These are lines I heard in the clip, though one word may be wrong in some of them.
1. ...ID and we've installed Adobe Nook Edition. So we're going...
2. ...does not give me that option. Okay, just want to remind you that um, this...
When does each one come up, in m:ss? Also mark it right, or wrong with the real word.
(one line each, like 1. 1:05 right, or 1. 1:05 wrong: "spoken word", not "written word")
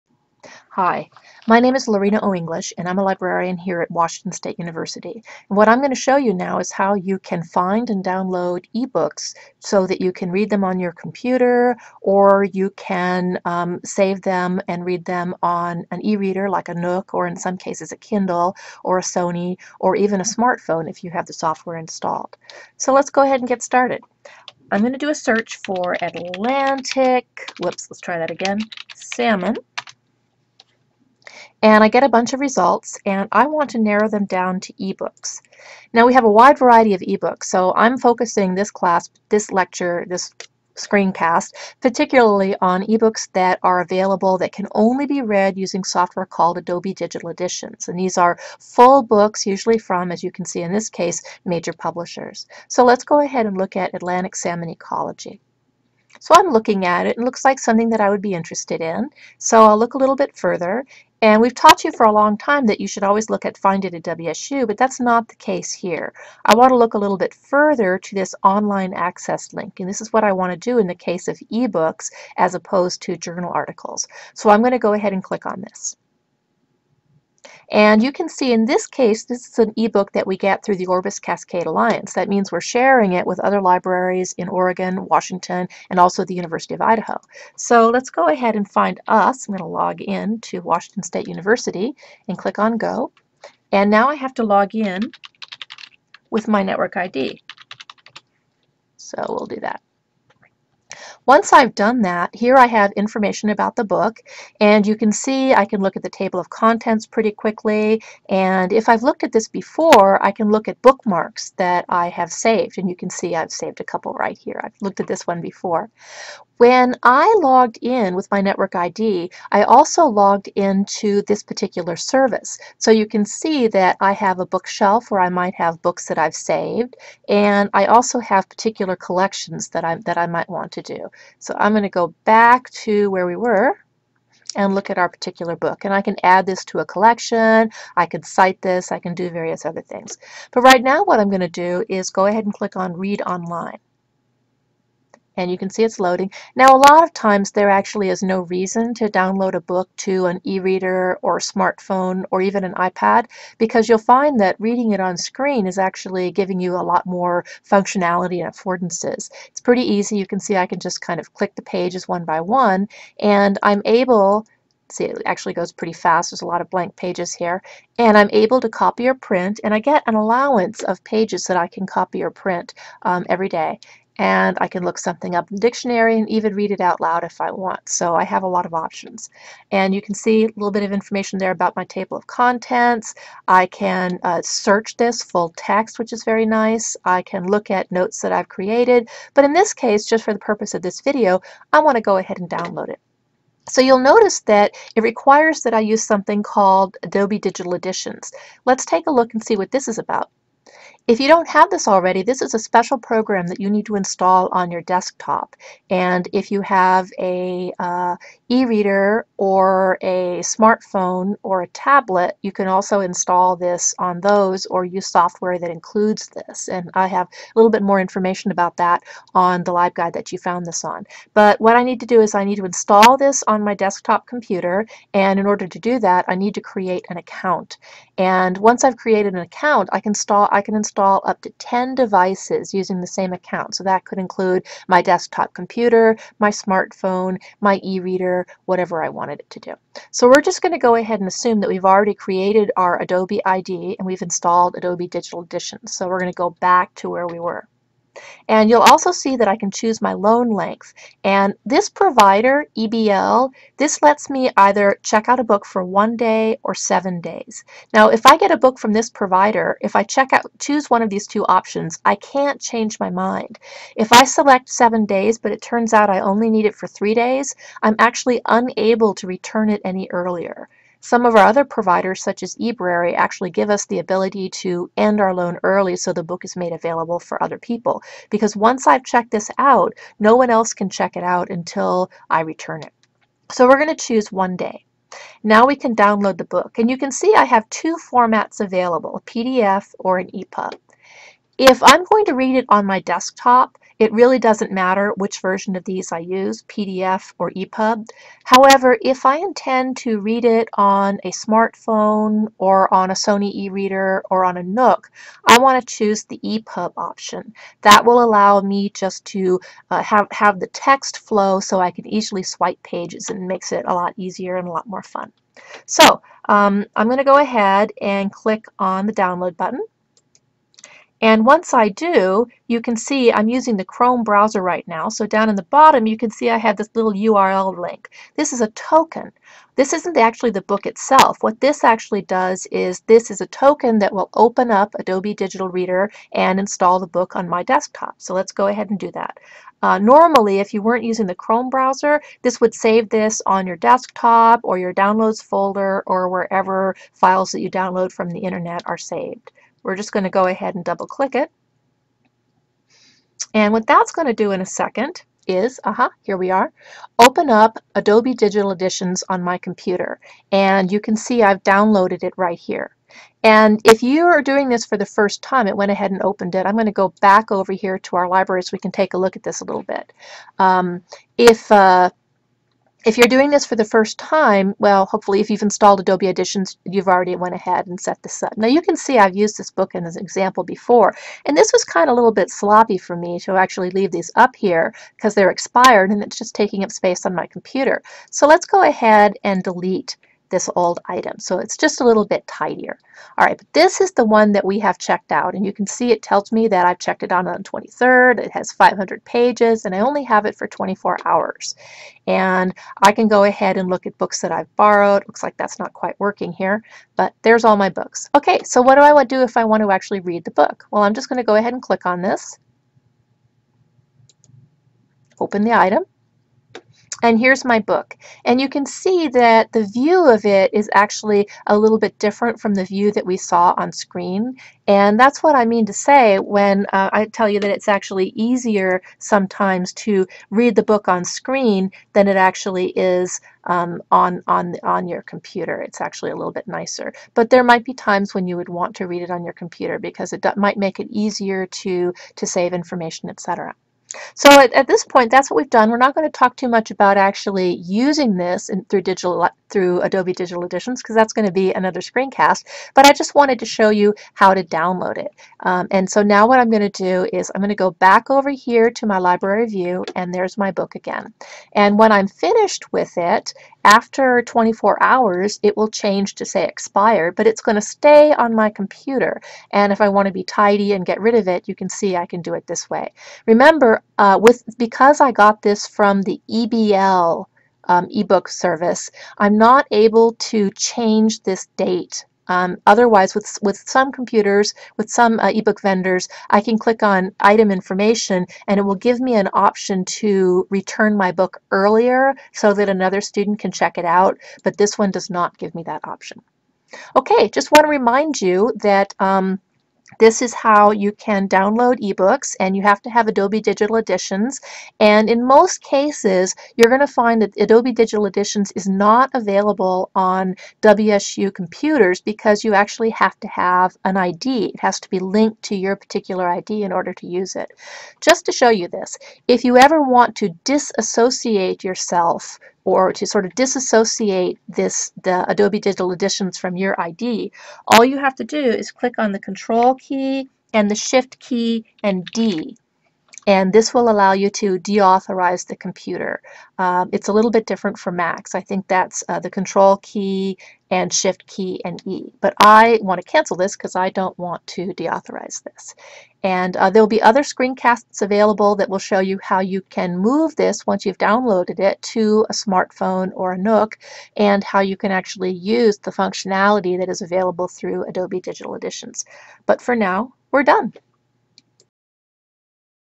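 1. 4:03 wrong: "Digital", not "Nook"
2. 8:15 right.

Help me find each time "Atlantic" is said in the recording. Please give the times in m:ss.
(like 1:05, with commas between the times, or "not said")
0:26, 0:53.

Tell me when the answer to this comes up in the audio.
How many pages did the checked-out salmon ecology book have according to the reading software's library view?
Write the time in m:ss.
6:38.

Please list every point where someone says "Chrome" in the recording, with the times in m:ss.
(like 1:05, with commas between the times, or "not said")
5:23, 5:41.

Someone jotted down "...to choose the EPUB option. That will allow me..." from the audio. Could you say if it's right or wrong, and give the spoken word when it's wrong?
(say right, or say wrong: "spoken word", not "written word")
right.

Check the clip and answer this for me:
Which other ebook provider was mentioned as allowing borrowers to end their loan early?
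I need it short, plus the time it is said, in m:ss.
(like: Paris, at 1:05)
eBrary, at 4:32.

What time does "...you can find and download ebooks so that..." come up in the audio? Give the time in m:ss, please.
0:06.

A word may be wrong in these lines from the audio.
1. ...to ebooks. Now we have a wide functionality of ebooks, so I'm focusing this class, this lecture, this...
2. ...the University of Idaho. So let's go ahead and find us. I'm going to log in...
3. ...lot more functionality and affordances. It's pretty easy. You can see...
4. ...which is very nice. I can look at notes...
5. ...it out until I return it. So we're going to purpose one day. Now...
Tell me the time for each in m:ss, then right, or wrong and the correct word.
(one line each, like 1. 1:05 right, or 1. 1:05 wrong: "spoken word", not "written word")
1. 0:34 wrong: "variety", not "functionality"
2. 1:26 right
3. 2:36 right
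4. 3:05 right
5. 4:41 wrong: "choose", not "purpose".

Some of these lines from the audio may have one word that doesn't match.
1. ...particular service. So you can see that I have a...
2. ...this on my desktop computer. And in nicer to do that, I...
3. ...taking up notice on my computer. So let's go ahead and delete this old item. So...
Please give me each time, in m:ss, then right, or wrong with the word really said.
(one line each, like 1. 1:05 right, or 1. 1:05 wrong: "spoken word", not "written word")
1. 2:01 right
2. 3:43 wrong: "order", not "nicer"
3. 6:26 wrong: "space", not "notice".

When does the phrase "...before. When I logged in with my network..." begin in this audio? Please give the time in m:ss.
1:55.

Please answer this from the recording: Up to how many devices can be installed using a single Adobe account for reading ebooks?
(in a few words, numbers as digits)
10.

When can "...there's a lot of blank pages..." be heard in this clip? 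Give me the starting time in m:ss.
2:46.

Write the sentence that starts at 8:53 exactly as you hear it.
And this will allow you to deauthorize the computer.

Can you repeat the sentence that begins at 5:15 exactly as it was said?
So um, I'm going to go ahead and click on the download button.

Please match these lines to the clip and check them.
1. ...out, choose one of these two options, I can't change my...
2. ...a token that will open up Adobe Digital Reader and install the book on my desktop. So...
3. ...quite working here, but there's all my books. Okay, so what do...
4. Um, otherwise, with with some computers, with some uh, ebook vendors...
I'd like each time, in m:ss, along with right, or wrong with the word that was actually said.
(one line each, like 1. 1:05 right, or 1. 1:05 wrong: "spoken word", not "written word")
1. 4:20 right
2. 5:33 right
3. 6:45 right
4. 8:02 right.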